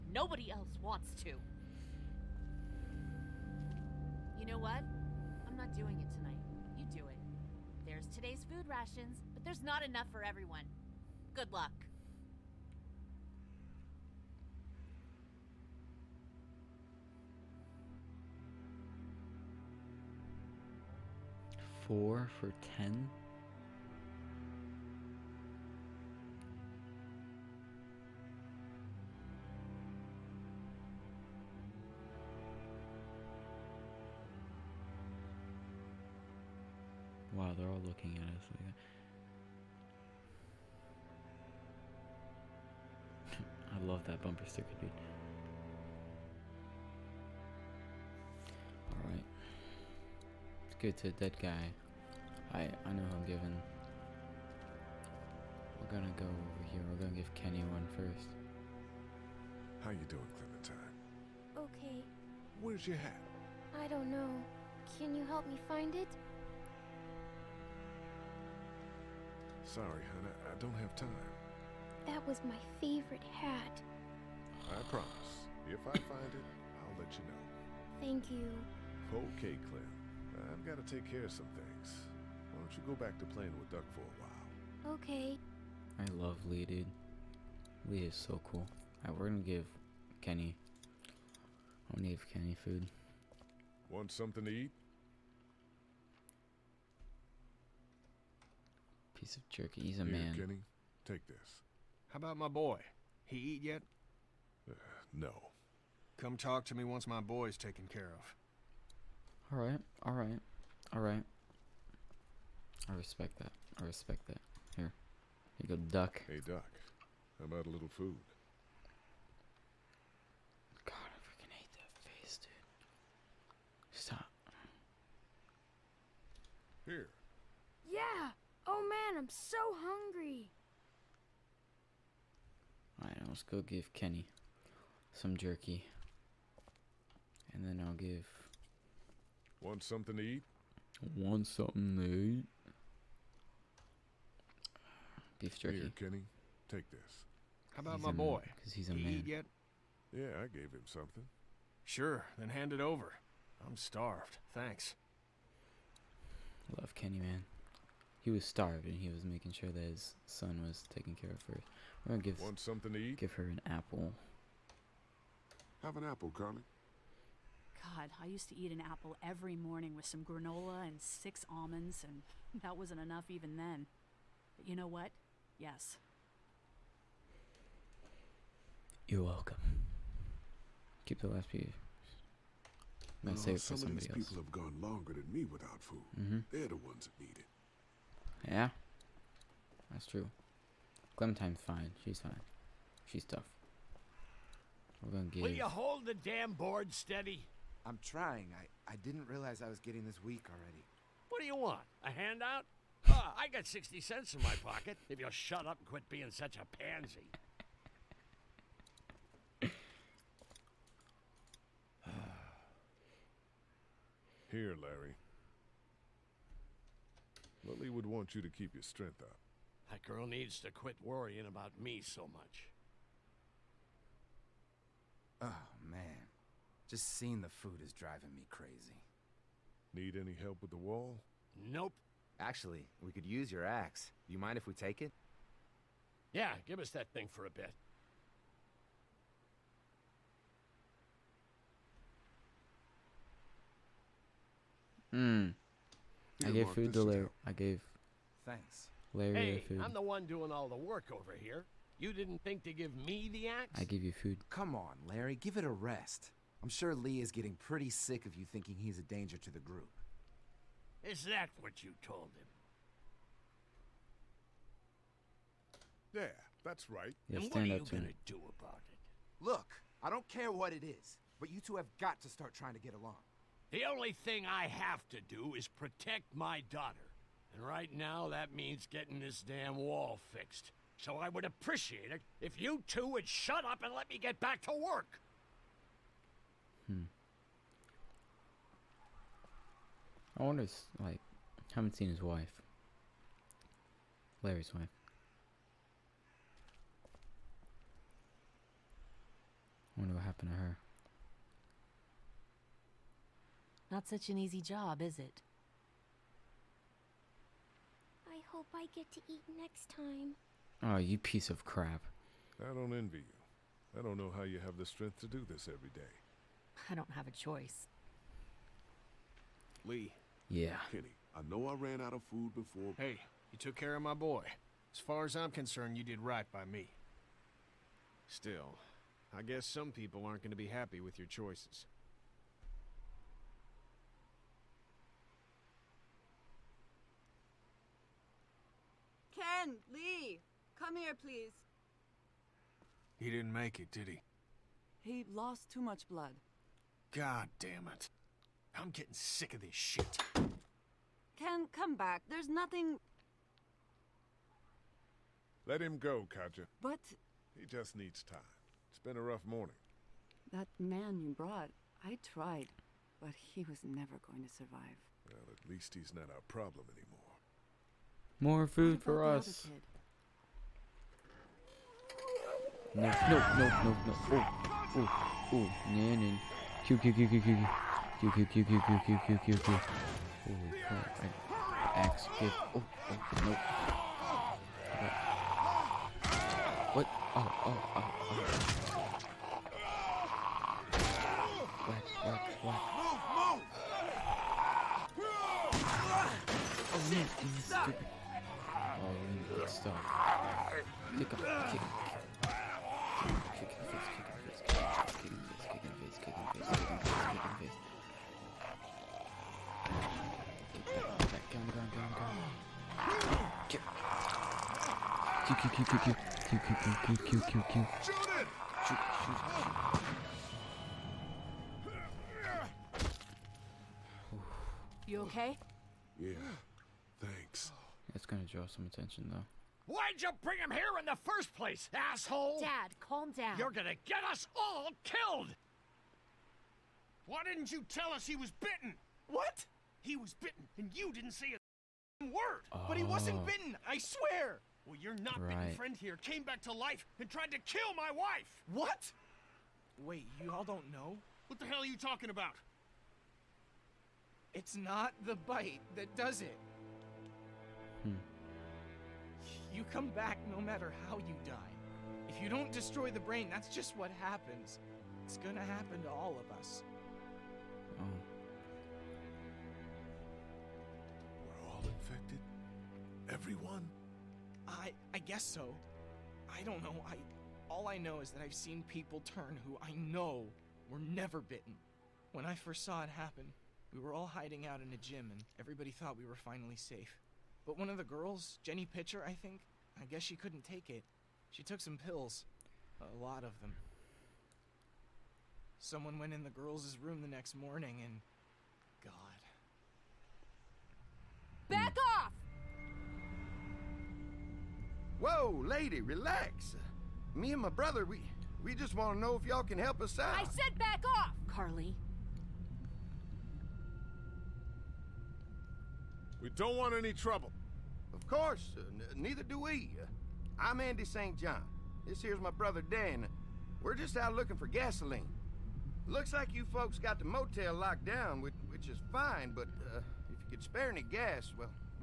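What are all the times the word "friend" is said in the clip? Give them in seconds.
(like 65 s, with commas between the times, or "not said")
445 s.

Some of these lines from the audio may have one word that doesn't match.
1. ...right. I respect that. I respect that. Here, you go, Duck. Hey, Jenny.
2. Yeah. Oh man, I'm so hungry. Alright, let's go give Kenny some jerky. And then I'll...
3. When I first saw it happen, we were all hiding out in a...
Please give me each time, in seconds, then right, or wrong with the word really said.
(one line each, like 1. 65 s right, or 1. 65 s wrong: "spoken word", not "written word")
1. 110 s wrong: "Duck", not "Jenny"
2. 127 s right
3. 482 s right.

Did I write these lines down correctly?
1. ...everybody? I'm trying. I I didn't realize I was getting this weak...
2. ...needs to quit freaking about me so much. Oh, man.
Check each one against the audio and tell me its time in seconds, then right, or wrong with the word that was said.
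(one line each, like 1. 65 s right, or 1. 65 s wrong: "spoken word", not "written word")
1. 196 s wrong: "steady", not "everybody"
2. 220 s wrong: "worrying", not "freaking".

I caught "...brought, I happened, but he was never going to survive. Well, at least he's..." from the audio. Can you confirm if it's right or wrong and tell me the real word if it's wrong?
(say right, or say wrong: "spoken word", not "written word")
wrong: "tried", not "happened".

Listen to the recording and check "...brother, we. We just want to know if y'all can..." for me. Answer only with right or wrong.
right.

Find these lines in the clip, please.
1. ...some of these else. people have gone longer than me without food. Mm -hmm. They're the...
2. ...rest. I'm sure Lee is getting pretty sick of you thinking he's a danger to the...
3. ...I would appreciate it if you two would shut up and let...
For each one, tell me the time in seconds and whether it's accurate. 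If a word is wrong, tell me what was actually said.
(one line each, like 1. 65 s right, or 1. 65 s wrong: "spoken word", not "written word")
1. 183 s right
2. 255 s right
3. 281 s right.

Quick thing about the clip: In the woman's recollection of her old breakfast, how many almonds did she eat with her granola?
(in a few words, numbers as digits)
6.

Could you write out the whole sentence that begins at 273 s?
The only thing I have to do is protect my daughter.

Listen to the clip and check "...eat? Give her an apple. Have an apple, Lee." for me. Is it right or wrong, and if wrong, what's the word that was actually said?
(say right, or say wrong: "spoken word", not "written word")
wrong: "Carley", not "Lee".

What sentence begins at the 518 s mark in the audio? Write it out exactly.
Of course, uh, neither do we.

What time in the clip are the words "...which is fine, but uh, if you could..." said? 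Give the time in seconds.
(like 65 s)
528 s.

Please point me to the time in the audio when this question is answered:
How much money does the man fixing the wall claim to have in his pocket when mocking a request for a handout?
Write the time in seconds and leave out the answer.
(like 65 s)
203 s.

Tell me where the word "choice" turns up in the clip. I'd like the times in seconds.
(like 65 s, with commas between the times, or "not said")
317 s, 331 s.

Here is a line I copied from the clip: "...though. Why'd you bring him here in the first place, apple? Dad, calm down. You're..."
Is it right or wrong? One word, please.
wrong.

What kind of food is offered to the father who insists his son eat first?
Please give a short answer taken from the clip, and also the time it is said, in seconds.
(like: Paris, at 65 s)
Beef jerky, at 145 s.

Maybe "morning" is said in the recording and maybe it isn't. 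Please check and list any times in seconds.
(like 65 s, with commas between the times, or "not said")
169 s, 359 s, 497 s.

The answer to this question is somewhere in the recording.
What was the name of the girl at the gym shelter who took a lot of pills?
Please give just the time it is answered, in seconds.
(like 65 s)
488 s.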